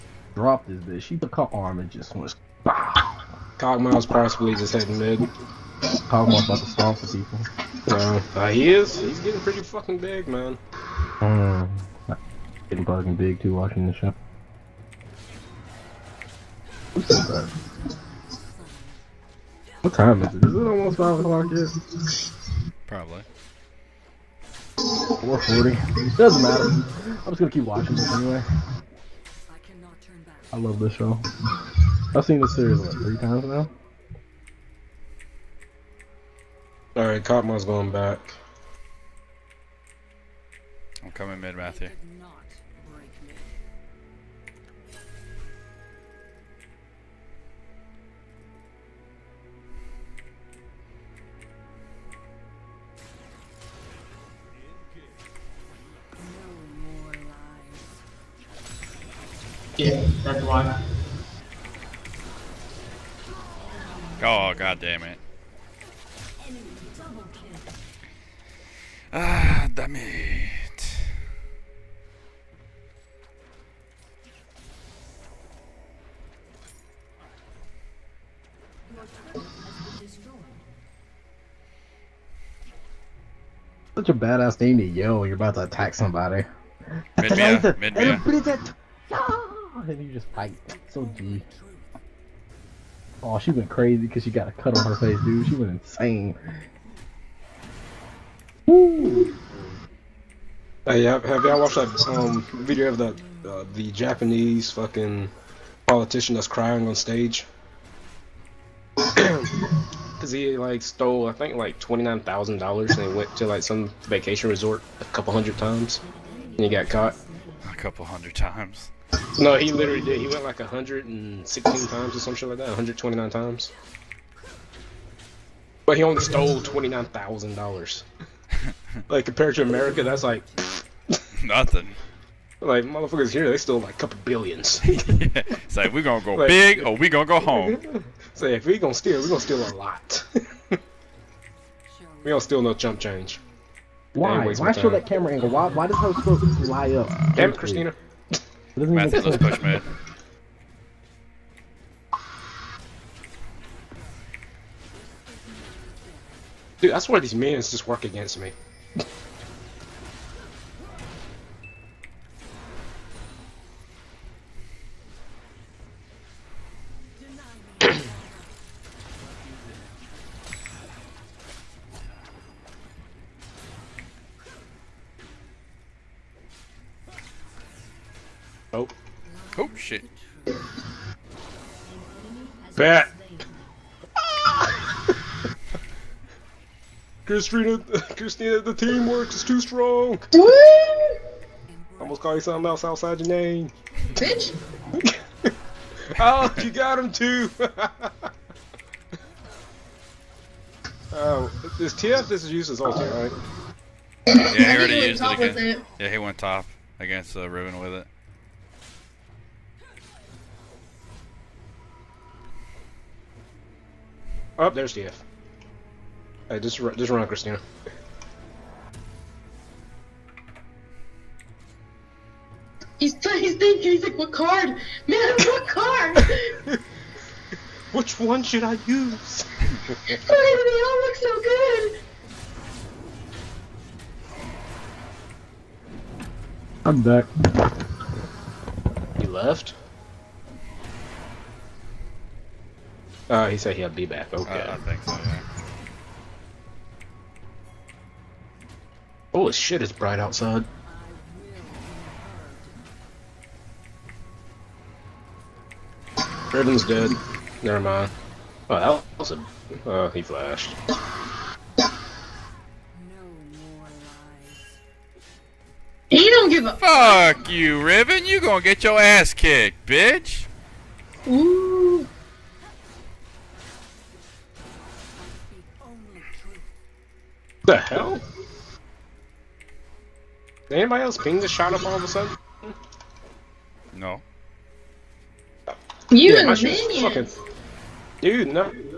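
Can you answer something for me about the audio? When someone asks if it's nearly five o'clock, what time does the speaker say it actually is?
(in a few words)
4:40.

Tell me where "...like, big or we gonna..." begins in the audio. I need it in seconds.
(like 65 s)
136 s.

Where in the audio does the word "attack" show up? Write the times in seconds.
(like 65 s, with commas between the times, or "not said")
85 s.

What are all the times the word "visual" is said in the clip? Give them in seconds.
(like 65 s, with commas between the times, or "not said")
not said.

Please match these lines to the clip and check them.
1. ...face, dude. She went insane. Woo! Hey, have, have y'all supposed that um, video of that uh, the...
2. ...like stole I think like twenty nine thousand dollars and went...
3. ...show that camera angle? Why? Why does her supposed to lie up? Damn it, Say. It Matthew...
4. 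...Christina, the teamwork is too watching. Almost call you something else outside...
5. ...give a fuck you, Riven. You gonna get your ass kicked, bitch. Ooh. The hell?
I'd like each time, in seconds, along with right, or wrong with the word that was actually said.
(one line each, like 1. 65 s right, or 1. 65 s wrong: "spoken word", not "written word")
1. 94 s wrong: "watched", not "supposed"
2. 110 s right
3. 144 s wrong: "Christina", not "Say"
4. 188 s wrong: "strong", not "watching"
5. 266 s right.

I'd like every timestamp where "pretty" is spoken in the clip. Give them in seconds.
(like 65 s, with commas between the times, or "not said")
9 s.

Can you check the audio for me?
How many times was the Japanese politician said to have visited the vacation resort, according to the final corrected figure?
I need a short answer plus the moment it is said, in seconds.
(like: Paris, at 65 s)
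129, at 122 s.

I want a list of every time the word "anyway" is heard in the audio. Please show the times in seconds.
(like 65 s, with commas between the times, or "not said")
28 s.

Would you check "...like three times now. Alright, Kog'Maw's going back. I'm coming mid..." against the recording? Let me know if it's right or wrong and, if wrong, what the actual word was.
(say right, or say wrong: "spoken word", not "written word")
right.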